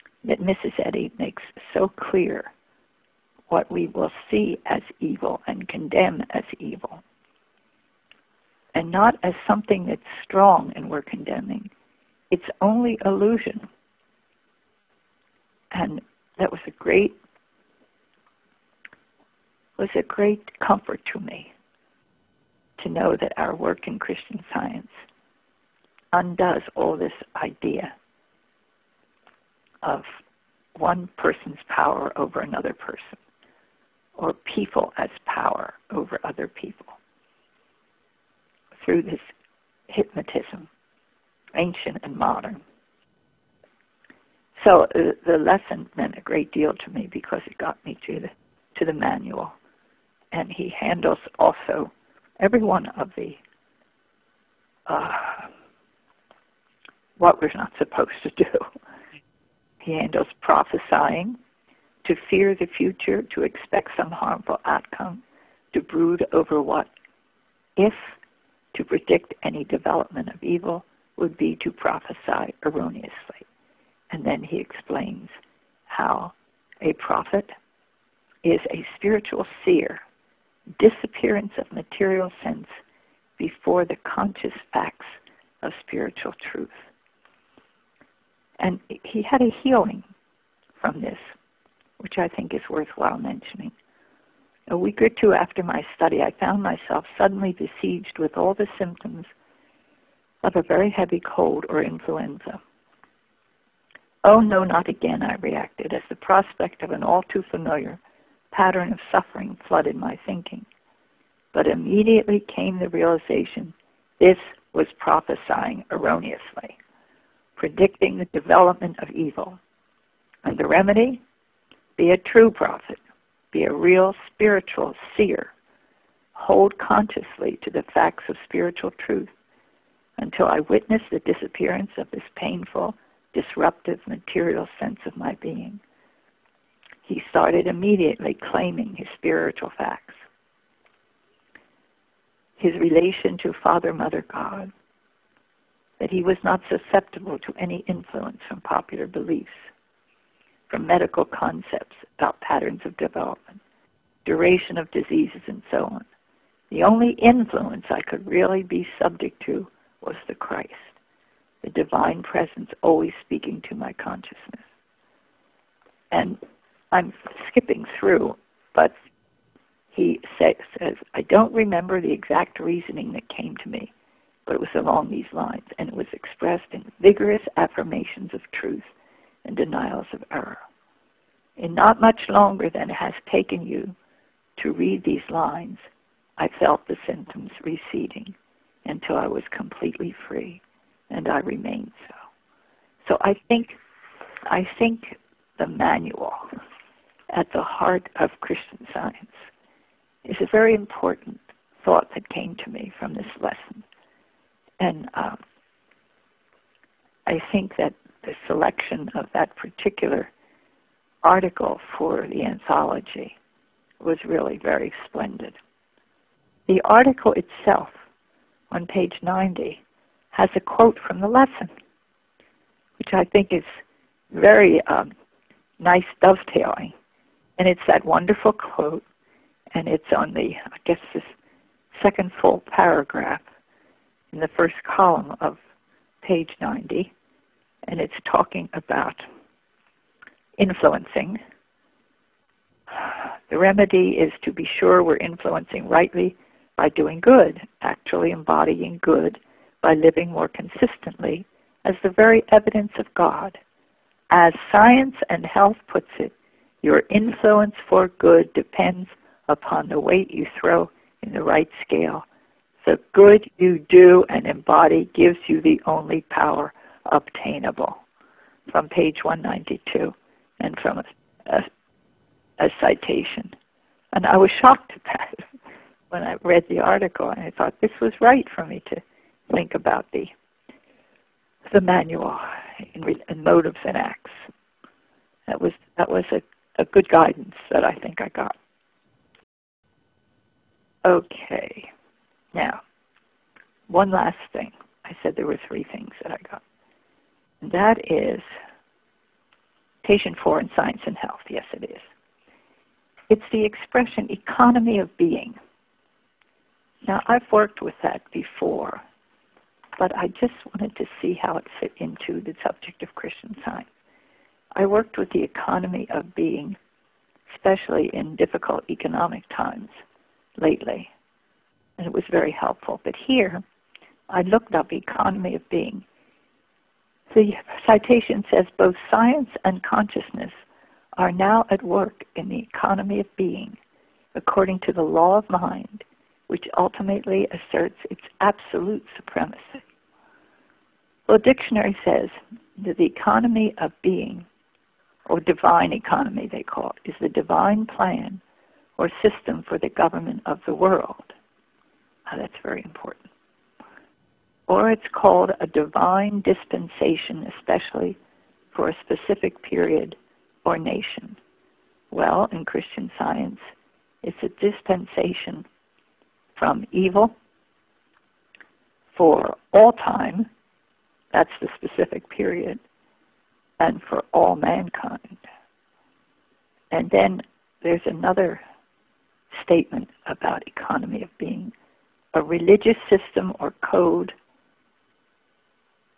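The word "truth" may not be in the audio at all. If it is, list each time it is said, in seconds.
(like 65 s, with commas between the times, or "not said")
86 s, 129 s, 178 s.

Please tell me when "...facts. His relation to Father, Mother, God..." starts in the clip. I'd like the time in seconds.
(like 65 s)
139 s.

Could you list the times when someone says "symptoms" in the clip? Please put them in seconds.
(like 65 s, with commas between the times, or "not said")
98 s, 187 s.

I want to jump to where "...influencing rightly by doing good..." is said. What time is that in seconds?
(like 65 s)
245 s.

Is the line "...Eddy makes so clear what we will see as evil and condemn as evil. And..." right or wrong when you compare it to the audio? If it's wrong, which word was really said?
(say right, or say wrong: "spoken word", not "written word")
right.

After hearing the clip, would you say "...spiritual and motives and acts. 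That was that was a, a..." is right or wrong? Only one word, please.
wrong.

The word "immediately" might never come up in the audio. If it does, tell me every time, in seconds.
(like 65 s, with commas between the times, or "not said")
111 s, 137 s.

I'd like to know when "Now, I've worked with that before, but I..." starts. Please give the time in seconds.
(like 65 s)
307 s.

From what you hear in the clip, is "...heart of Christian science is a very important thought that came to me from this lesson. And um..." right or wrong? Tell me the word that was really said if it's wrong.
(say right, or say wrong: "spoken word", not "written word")
right.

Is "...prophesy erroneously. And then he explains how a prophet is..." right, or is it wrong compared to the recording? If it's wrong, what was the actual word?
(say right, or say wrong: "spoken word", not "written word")
right.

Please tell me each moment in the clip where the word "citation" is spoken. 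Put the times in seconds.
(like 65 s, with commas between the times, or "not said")
272 s, 327 s.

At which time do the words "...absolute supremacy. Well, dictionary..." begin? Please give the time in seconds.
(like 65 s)
338 s.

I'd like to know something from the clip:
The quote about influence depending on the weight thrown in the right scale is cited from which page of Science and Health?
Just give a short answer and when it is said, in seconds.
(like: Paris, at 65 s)
192, at 268 s.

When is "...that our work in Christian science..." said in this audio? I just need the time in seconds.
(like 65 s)
23 s.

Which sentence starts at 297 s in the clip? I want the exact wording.
And that is patient four in science and health.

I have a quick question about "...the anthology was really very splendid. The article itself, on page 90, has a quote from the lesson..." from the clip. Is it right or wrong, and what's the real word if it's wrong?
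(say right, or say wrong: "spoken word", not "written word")
right.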